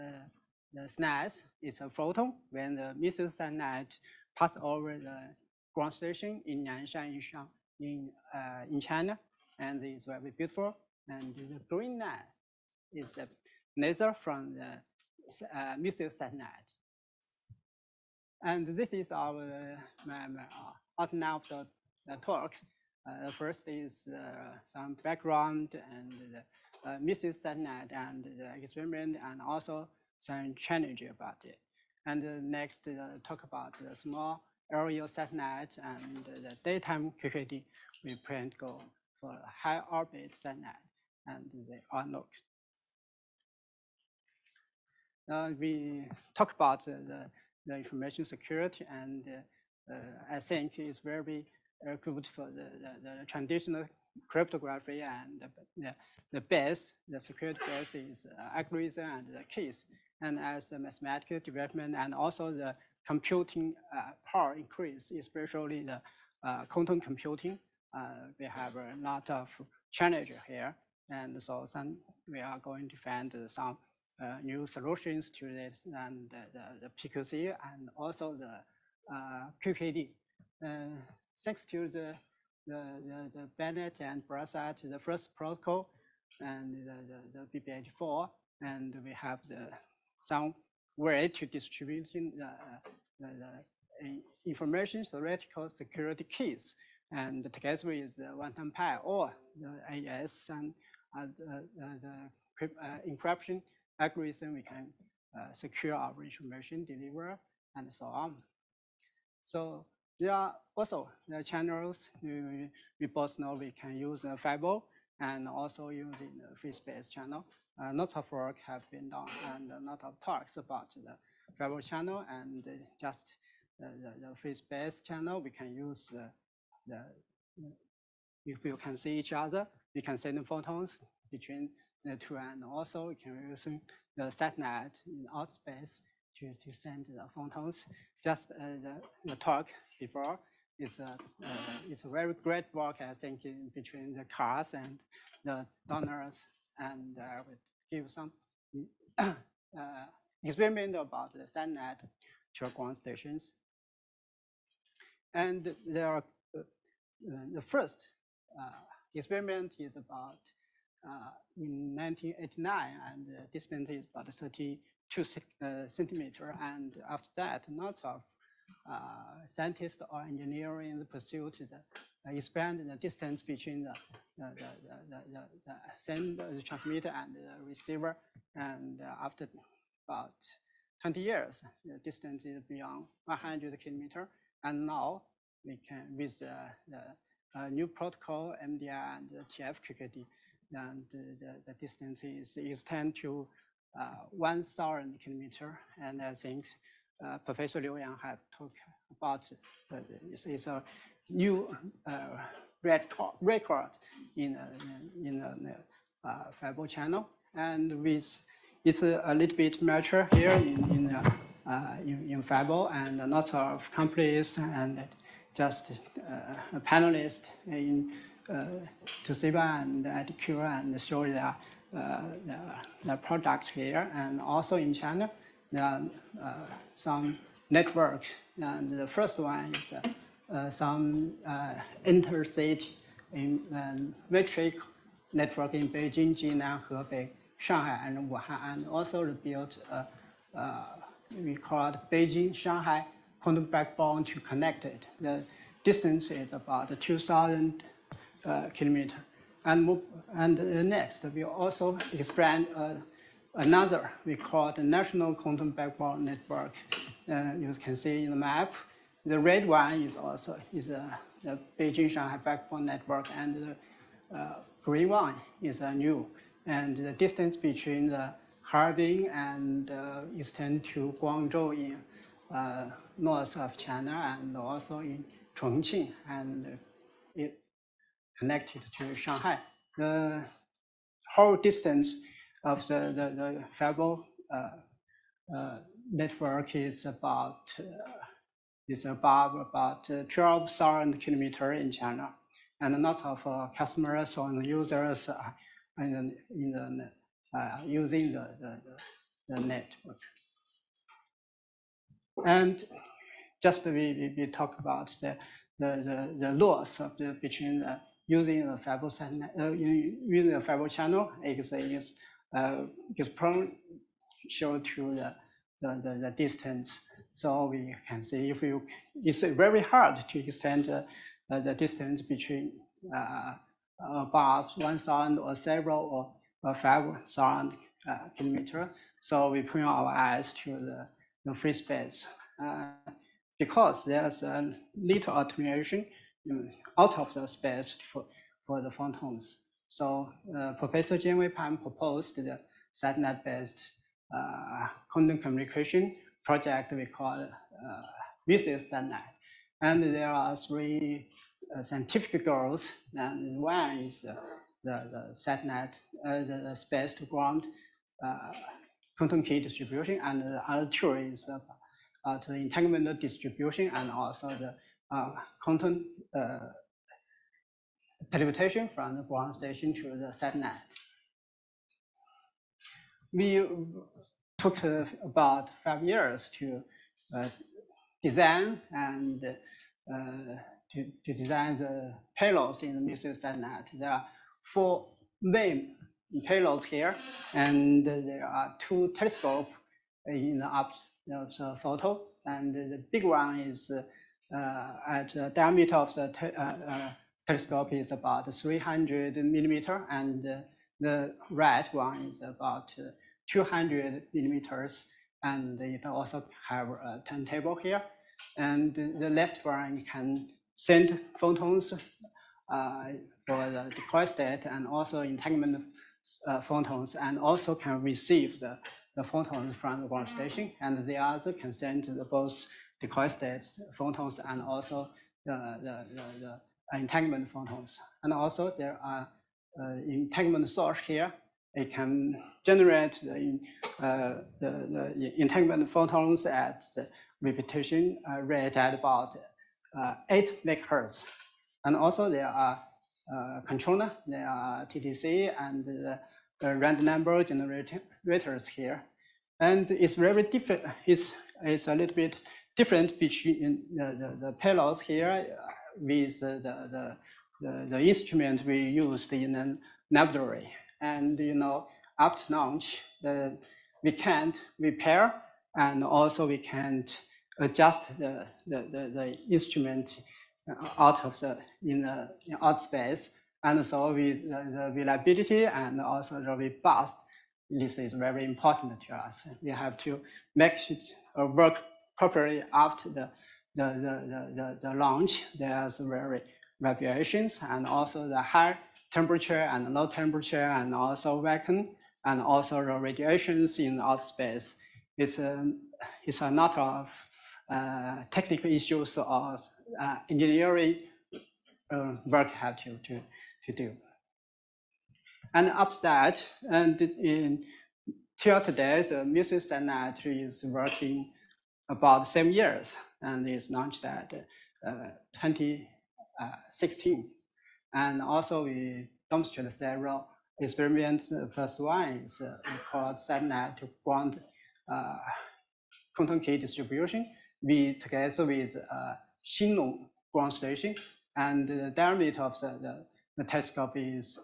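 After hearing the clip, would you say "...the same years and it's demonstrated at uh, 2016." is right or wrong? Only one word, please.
wrong.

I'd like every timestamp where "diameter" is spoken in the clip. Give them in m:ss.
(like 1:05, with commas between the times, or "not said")
6:35, 8:51.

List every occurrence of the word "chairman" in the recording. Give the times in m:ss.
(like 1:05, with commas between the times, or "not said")
not said.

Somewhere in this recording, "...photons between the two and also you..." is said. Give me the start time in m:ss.
2:10.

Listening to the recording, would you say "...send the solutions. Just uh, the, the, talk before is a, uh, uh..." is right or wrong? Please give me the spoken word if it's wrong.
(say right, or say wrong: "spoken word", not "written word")
wrong: "photons", not "solutions".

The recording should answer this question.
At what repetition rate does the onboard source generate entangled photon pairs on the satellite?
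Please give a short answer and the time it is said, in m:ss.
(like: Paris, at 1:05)
8 megahertz, at 7:20.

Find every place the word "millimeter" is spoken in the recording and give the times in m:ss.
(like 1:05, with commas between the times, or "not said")
6:39, 6:44.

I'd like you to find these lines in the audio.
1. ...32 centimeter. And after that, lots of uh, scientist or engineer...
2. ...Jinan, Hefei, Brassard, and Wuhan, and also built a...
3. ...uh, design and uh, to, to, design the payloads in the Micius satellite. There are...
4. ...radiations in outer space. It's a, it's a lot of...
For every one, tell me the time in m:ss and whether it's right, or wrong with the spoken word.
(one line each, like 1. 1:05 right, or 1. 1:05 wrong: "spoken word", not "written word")
1. 2:44 right
2. 3:56 wrong: "Shanghai", not "Brassard"
3. 6:17 right
4. 8:12 right.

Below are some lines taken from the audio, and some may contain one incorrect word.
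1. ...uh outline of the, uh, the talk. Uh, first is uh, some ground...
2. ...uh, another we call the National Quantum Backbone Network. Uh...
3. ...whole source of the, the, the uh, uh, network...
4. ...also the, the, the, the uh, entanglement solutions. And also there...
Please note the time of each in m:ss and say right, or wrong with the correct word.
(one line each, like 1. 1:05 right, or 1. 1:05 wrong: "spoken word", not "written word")
1. 0:20 wrong: "background", not "ground"
2. 4:12 right
3. 4:41 wrong: "distance", not "source"
4. 7:04 wrong: "photons", not "solutions".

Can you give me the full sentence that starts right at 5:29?
So we point our eyes to the, the free space.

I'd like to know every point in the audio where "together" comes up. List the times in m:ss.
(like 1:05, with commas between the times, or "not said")
1:37, 8:47.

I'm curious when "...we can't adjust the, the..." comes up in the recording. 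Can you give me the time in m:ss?
7:46.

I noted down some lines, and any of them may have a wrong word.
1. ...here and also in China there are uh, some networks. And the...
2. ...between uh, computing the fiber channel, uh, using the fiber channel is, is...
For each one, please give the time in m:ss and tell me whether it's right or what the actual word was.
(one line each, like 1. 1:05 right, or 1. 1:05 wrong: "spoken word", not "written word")
1. 3:43 right
2. 5:07 wrong: "using", not "computing".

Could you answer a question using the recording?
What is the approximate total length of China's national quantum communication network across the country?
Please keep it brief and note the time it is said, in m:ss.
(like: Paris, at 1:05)
12,000 kilometers, at 4:50.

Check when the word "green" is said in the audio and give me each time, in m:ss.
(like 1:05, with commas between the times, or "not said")
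0:11, 4:24.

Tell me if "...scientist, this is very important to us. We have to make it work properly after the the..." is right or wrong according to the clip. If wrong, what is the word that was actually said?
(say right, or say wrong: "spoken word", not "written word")
wrong: "robust", not "scientist".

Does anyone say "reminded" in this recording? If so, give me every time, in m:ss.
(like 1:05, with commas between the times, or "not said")
not said.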